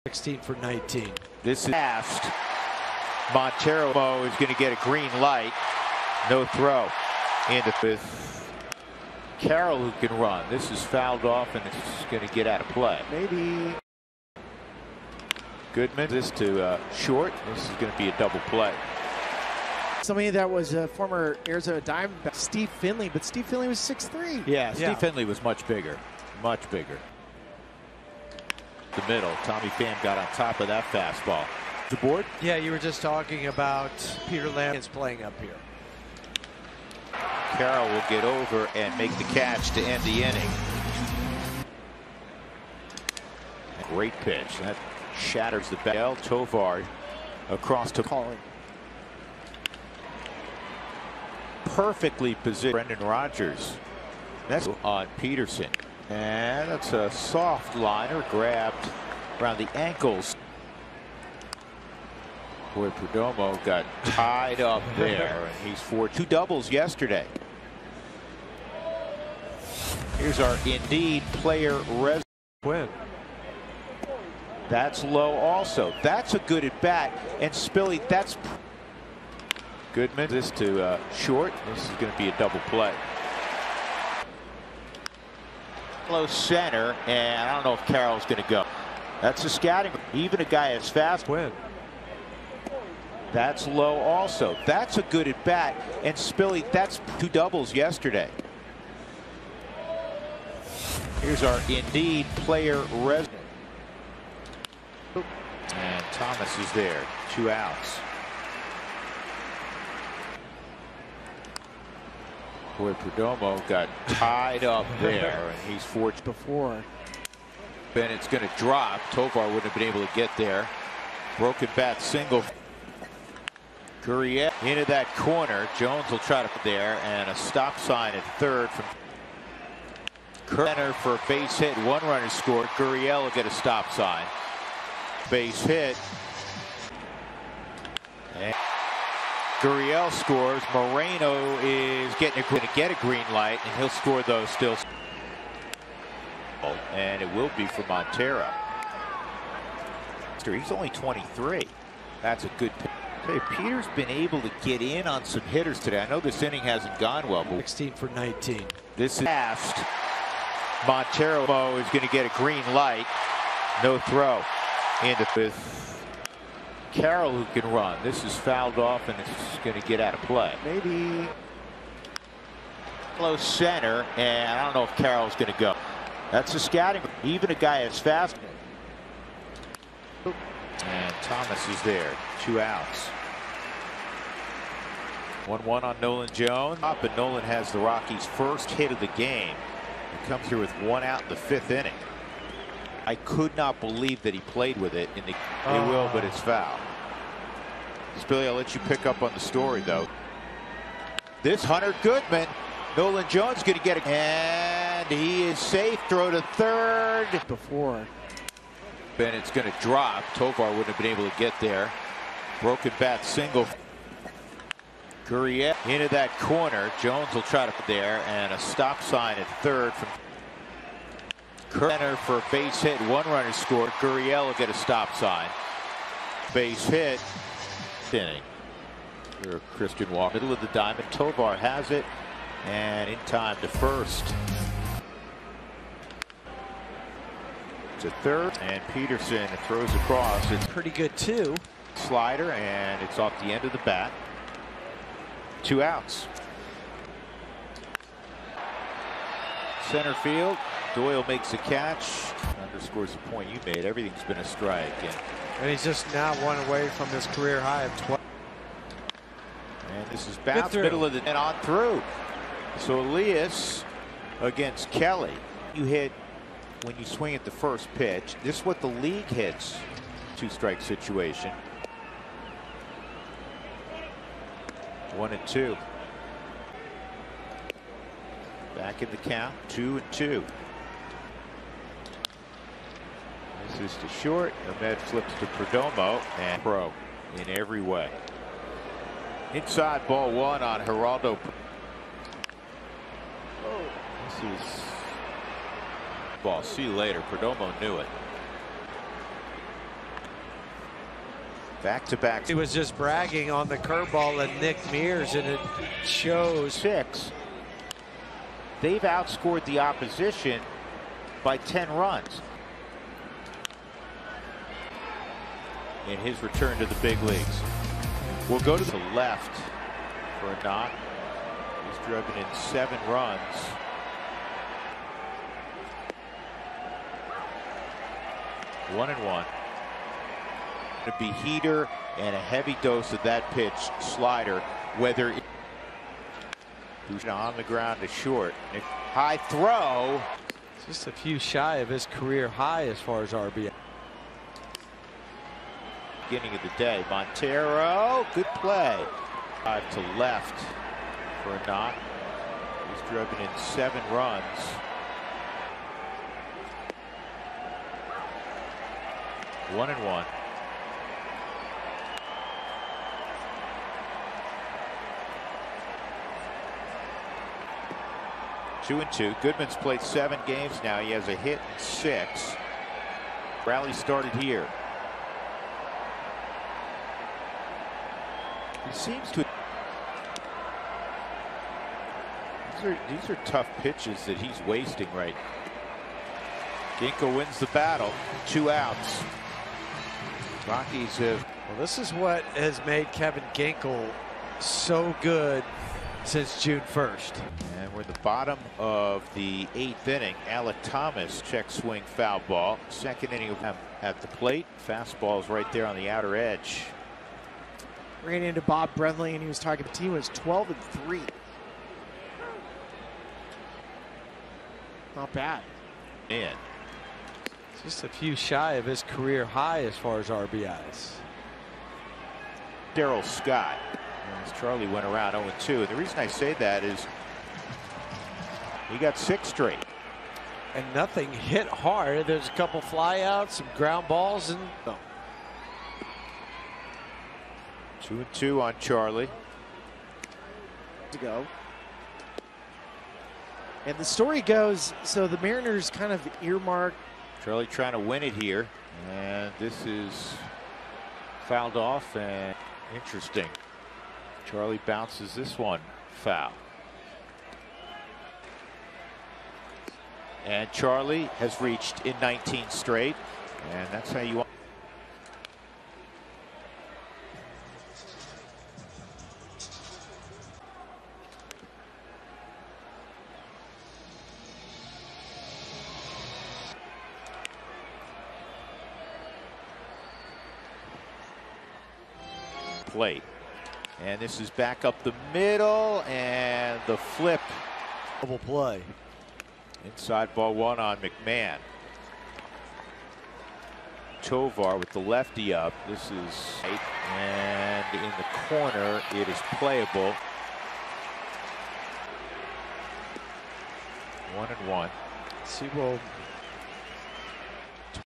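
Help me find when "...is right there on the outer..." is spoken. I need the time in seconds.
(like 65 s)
405 s.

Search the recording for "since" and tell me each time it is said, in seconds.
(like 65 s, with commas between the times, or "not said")
396 s.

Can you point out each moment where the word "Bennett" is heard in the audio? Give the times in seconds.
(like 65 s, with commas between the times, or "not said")
117 s, 209 s.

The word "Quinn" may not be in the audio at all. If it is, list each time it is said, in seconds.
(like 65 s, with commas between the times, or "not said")
72 s.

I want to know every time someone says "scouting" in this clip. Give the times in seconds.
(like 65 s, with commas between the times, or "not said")
89 s, 176 s.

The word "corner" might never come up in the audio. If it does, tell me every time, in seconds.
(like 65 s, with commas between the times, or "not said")
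125 s, 216 s, 498 s.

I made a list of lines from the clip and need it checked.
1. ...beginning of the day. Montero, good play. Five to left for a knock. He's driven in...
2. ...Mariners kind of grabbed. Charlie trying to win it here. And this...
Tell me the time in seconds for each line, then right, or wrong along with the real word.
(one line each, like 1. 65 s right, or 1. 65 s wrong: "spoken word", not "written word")
1. 346 s right
2. 445 s wrong: "earmarked", not "grabbed".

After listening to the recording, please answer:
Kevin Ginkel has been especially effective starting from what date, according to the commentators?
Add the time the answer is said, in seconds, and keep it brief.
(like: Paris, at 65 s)
June 1st, at 396 s.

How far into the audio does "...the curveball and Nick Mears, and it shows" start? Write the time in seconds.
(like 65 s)
303 s.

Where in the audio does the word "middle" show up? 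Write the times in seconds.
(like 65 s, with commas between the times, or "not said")
29 s, 230 s, 260 s, 485 s.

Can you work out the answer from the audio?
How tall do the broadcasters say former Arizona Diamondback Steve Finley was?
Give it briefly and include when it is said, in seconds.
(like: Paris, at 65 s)
6'3", at 23 s.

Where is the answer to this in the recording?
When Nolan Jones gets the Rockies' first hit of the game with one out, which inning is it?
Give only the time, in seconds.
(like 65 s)
191 s.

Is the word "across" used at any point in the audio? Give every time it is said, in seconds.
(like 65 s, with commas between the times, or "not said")
47 s, 239 s.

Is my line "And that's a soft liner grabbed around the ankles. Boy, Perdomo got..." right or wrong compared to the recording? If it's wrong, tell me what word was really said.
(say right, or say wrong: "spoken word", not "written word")
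right.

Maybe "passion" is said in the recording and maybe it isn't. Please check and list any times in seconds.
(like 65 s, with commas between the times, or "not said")
not said.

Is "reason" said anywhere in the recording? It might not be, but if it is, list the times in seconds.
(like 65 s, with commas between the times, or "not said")
425 s.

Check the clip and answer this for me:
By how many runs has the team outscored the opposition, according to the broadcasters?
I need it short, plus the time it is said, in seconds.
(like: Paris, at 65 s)
10 runs, at 311 s.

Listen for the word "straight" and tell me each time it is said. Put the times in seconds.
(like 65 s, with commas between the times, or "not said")
429 s, 462 s.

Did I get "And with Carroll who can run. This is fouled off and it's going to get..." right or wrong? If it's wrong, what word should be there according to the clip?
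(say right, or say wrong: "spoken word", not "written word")
right.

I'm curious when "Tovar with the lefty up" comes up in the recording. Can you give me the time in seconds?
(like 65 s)
494 s.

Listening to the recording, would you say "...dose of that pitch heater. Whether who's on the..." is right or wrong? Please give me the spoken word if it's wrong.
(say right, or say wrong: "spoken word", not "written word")
wrong: "slider", not "heater".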